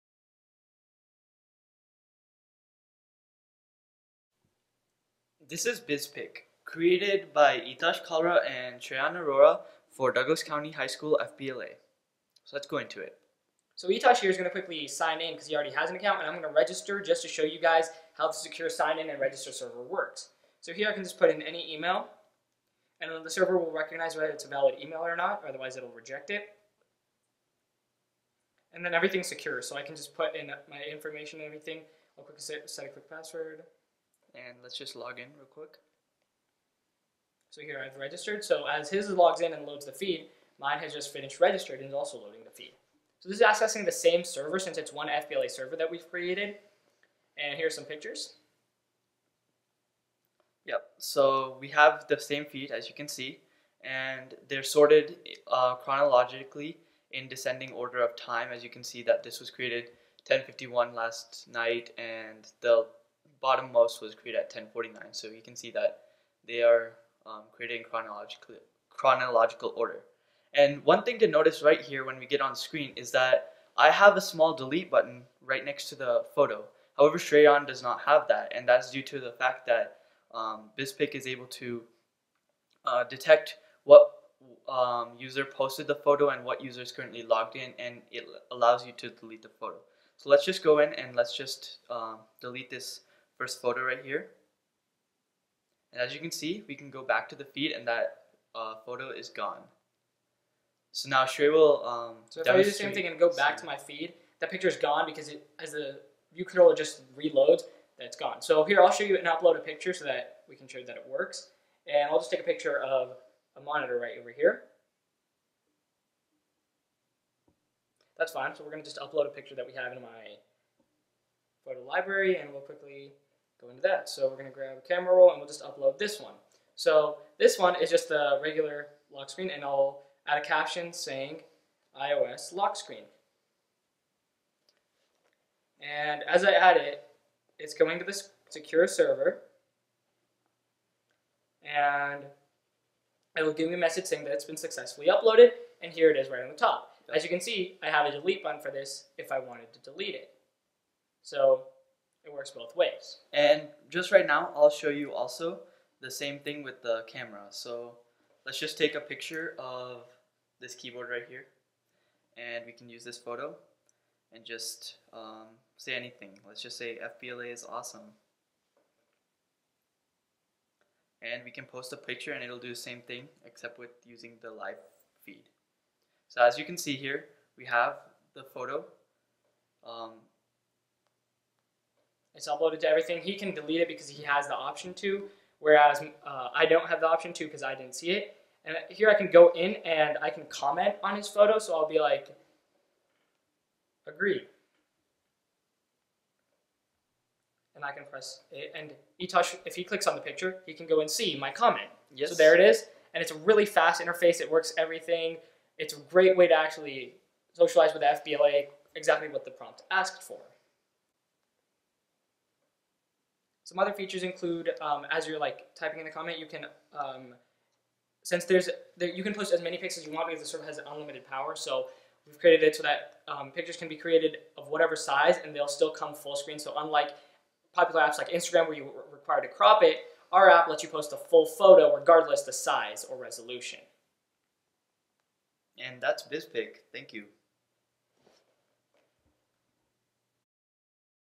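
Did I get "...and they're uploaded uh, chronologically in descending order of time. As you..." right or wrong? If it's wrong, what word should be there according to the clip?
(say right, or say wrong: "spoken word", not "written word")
wrong: "sorted", not "uploaded".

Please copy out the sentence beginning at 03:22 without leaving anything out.
So there it is, and it's a really fast interface.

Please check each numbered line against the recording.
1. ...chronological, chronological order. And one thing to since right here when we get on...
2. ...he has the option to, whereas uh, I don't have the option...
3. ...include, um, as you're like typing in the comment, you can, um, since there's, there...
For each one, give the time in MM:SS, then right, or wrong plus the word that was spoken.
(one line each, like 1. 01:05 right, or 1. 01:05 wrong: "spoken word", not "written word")
1. 01:07 wrong: "notice", not "since"
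2. 03:04 right
3. 03:34 right.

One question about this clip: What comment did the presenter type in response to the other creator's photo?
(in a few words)
agree.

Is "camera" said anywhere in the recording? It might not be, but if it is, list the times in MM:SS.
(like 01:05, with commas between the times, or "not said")
02:04, 02:37.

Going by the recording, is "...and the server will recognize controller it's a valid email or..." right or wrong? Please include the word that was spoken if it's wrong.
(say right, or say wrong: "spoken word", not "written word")
wrong: "whether", not "controller".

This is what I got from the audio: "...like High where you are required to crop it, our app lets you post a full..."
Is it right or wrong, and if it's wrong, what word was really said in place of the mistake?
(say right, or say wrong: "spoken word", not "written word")
wrong: "Instagram", not "High".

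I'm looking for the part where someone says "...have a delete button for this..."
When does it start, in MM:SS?
02:27.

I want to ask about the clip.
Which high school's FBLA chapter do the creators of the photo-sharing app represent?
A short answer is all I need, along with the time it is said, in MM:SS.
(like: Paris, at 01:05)
Douglas County High School, at 00:10.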